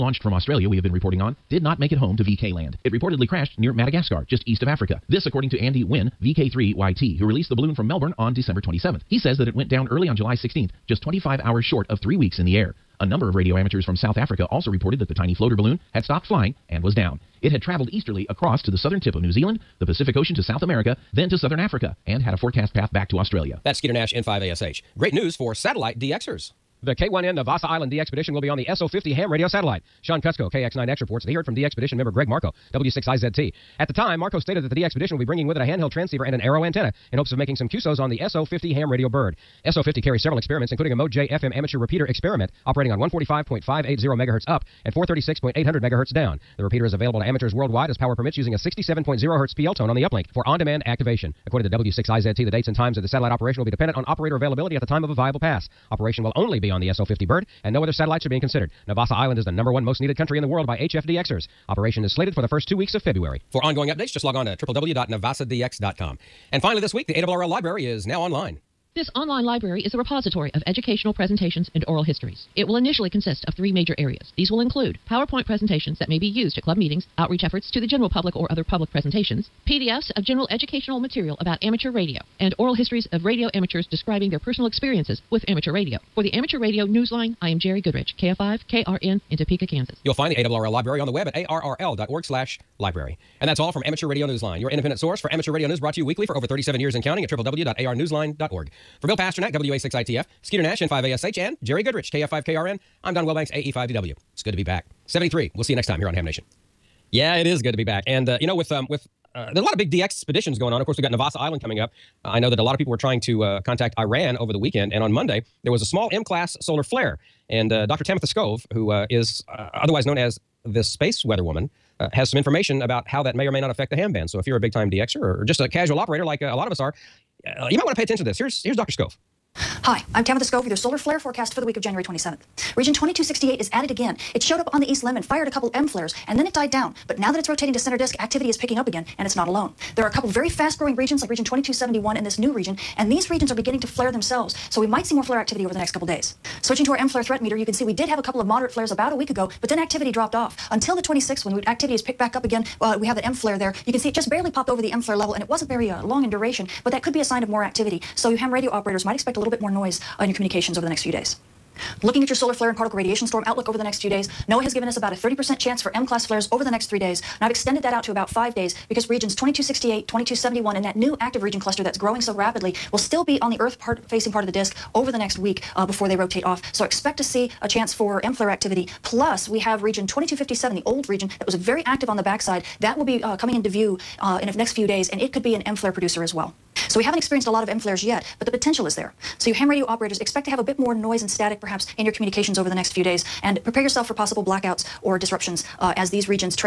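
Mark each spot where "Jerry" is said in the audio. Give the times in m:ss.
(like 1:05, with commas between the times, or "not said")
1:27, 1:41.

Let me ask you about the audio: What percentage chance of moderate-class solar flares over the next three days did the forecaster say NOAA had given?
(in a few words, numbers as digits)
30%.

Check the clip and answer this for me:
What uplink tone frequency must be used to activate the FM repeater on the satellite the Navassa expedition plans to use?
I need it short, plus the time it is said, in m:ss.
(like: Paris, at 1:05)
67.0 Hz, at 0:48.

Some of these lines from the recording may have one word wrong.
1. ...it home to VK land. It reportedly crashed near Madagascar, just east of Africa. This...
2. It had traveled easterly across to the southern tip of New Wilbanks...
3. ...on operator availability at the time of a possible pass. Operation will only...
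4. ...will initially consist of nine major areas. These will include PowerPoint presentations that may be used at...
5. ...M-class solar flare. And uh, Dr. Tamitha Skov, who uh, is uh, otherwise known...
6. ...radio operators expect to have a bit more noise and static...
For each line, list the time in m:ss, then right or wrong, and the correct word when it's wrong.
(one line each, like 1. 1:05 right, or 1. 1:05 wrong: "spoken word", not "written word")
1. 0:01 right
2. 0:17 wrong: "Zealand", not "Wilbanks"
3. 0:53 wrong: "viable", not "possible"
4. 1:12 wrong: "three", not "nine"
5. 1:56 right
6. 3:09 right.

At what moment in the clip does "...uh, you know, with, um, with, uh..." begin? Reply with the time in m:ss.
1:48.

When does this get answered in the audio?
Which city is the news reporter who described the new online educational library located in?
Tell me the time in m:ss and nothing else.
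1:29.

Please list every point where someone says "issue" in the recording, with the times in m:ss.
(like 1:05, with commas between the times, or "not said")
not said.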